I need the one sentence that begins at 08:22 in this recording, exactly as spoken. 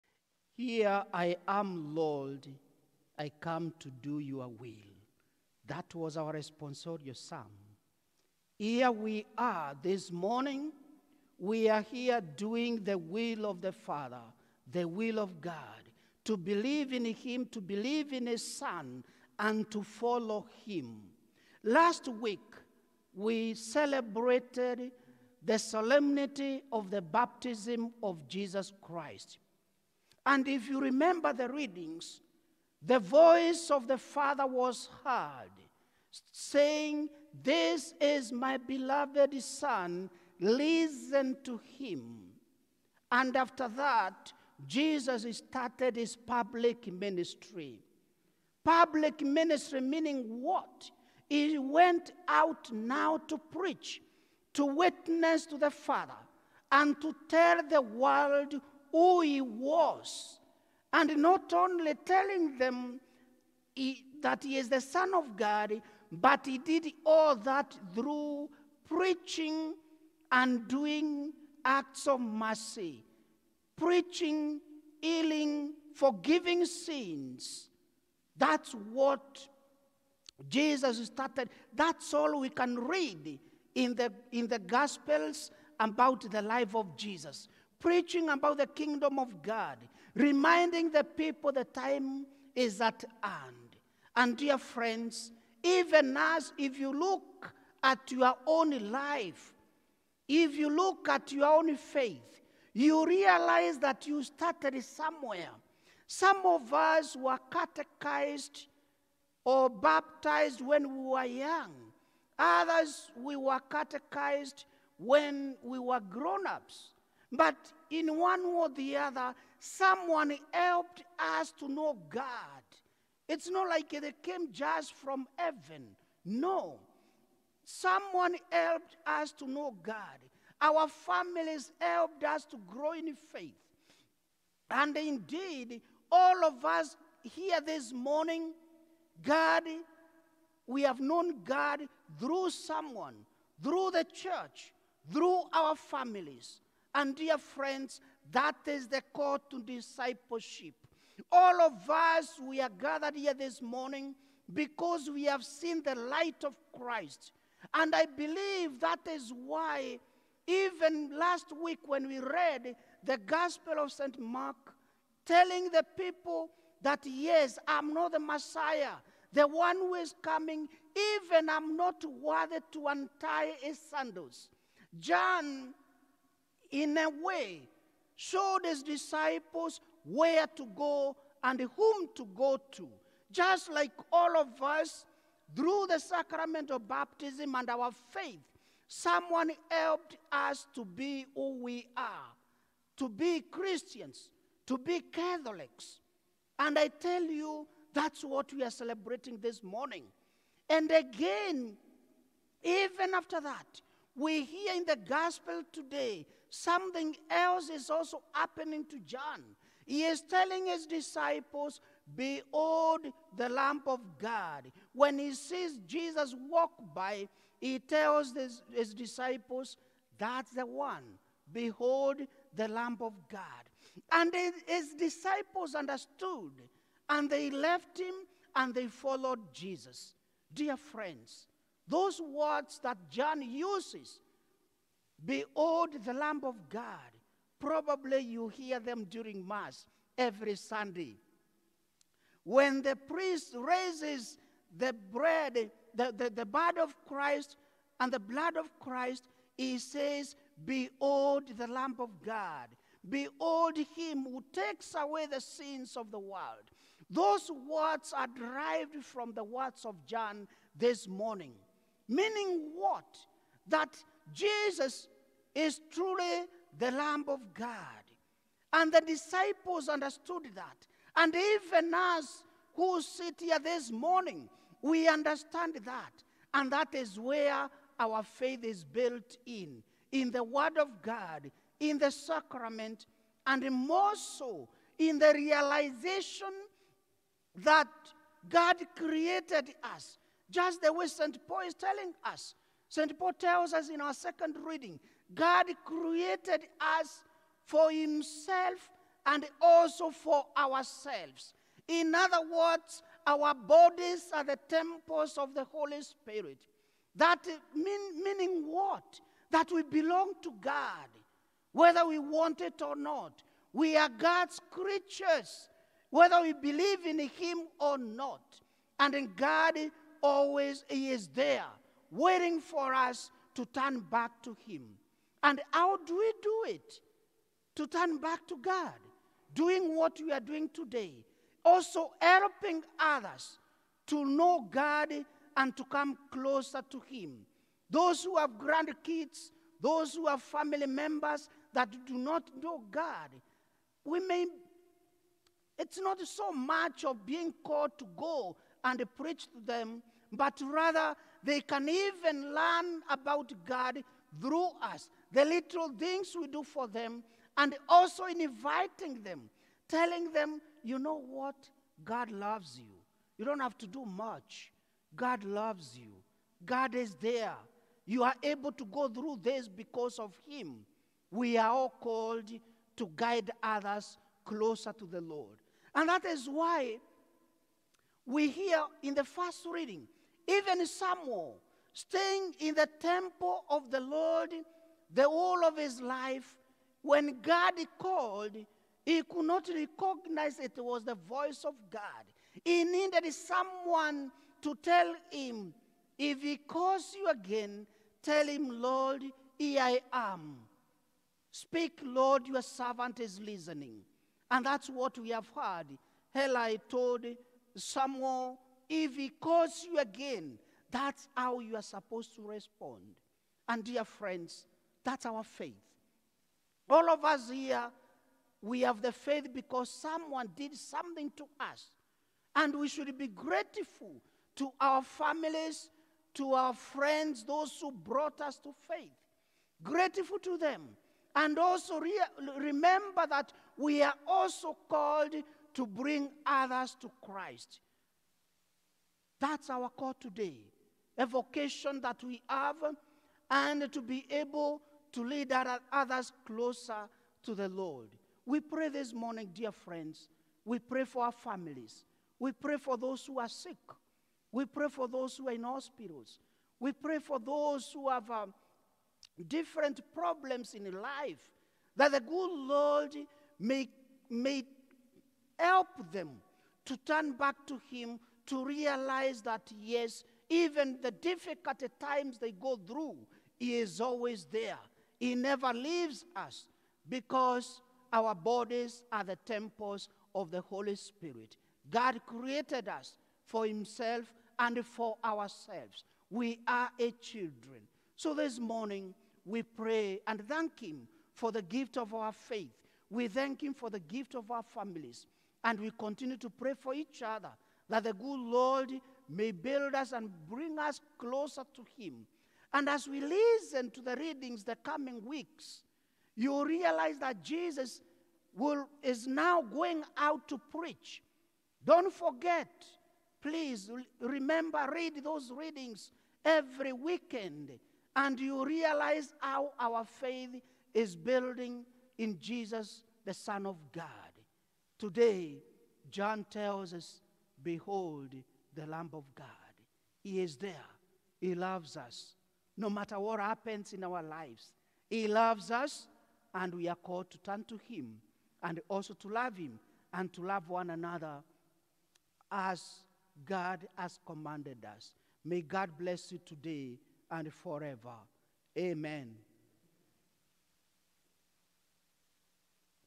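And as we listen to the readings the coming weeks, you realize that Jesus will, is now going out to preach.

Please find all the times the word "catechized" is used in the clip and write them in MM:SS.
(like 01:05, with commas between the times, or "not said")
01:47, 01:53.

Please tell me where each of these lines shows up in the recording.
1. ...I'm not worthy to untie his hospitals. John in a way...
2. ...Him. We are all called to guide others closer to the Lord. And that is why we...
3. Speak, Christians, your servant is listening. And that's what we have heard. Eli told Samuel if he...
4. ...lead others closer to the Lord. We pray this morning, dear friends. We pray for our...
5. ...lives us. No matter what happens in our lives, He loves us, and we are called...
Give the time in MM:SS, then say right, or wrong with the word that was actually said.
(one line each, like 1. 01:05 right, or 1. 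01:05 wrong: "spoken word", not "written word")
1. 02:51 wrong: "sandals", not "hospitals"
2. 06:10 right
3. 06:41 wrong: "Lord", not "Christians"
4. 07:25 right
5. 08:51 wrong: "loves", not "lives".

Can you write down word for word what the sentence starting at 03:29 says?
He is telling his disciples, Behold the Lamb of God.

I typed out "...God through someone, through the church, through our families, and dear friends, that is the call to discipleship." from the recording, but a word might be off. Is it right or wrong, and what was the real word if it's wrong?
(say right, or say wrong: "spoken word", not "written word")
right.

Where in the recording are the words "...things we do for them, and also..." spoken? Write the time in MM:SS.
05:55.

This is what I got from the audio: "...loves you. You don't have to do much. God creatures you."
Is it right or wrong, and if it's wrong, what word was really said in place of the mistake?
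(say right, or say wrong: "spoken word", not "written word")
wrong: "loves", not "creatures".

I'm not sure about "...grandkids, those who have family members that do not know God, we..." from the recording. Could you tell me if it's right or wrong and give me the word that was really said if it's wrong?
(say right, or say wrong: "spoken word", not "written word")
right.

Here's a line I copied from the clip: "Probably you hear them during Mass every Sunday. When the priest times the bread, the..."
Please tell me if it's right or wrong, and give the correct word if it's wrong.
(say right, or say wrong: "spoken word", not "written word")
wrong: "raises", not "times".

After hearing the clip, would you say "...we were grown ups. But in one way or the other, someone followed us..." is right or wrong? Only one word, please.
wrong.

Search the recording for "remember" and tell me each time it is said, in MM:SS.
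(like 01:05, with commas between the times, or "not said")
00:30, 07:12, 08:34.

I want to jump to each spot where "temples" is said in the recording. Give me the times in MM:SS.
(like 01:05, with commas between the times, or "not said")
05:04, 06:22, 07:59.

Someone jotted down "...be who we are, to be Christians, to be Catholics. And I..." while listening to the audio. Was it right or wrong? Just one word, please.
right.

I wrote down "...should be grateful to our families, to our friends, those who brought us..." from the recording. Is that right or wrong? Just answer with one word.
right.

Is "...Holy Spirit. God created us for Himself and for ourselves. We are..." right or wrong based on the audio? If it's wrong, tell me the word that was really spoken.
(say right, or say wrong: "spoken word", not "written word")
right.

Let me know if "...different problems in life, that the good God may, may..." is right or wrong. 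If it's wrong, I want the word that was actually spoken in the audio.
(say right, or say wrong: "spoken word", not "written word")
wrong: "Lord", not "God".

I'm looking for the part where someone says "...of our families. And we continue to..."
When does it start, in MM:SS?
08:14.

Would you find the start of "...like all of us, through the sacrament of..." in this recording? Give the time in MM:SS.
03:03.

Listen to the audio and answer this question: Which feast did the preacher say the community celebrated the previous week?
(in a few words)
Baptism of Jesus Christ.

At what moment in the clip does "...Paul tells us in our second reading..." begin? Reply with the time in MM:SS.
04:53.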